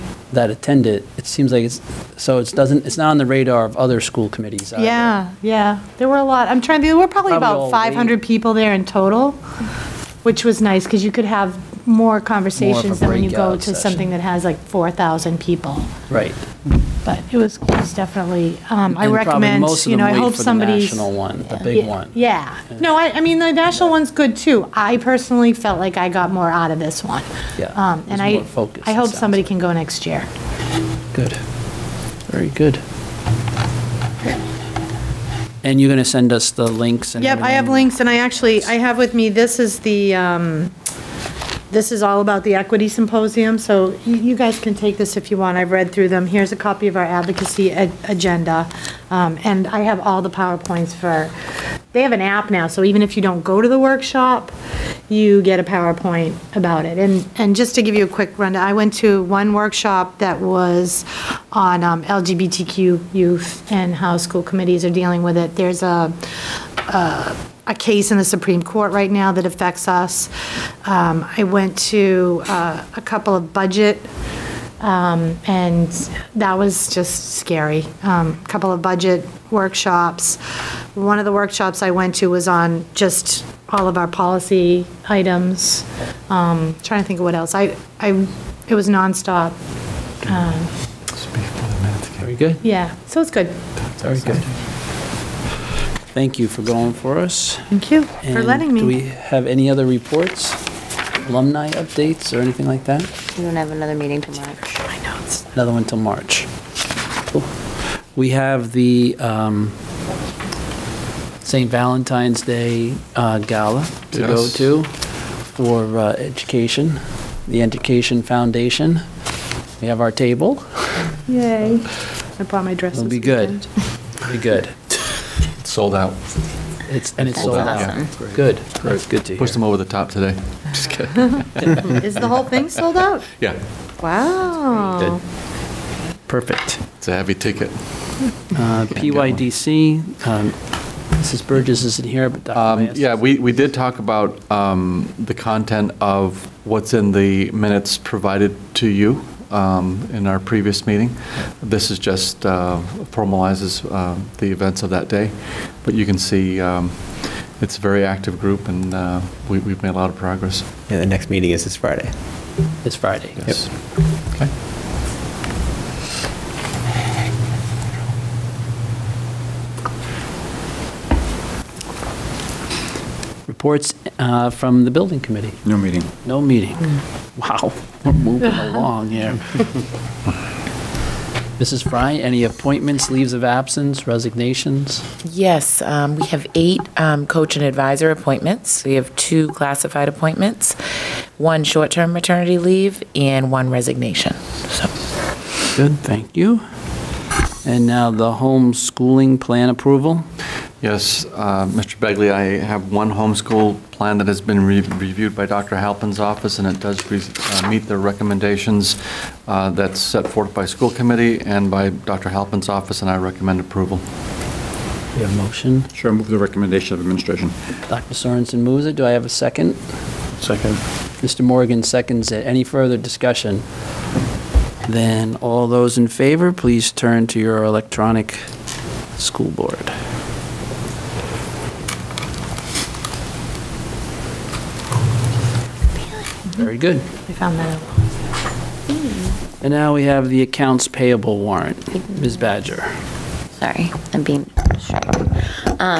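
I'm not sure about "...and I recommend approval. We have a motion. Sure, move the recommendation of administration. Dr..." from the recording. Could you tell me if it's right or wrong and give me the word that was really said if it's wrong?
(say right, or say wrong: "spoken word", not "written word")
right.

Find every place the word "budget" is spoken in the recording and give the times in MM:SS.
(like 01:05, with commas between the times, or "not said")
01:13, 01:18.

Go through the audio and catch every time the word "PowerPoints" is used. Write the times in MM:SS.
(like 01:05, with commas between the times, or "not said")
00:50, 00:55.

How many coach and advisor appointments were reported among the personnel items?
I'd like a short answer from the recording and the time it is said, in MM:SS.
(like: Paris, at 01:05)
8, at 03:06.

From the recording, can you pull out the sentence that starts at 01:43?
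We don't have another meeting tomorrow.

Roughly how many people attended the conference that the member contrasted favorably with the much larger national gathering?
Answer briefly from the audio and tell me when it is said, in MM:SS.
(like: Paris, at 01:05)
500, at 00:07.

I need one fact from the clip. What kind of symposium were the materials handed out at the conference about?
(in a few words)
Equity symposium.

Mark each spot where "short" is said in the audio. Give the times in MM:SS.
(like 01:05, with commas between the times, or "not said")
03:11.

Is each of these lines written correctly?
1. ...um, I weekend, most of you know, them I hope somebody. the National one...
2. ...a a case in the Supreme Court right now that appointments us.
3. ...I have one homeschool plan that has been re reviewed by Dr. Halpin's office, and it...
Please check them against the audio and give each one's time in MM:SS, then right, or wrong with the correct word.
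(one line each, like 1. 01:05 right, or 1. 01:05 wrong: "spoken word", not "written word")
1. 00:18 wrong: "recommend", not "weekend"
2. 01:06 wrong: "affects", not "appointments"
3. 03:22 right.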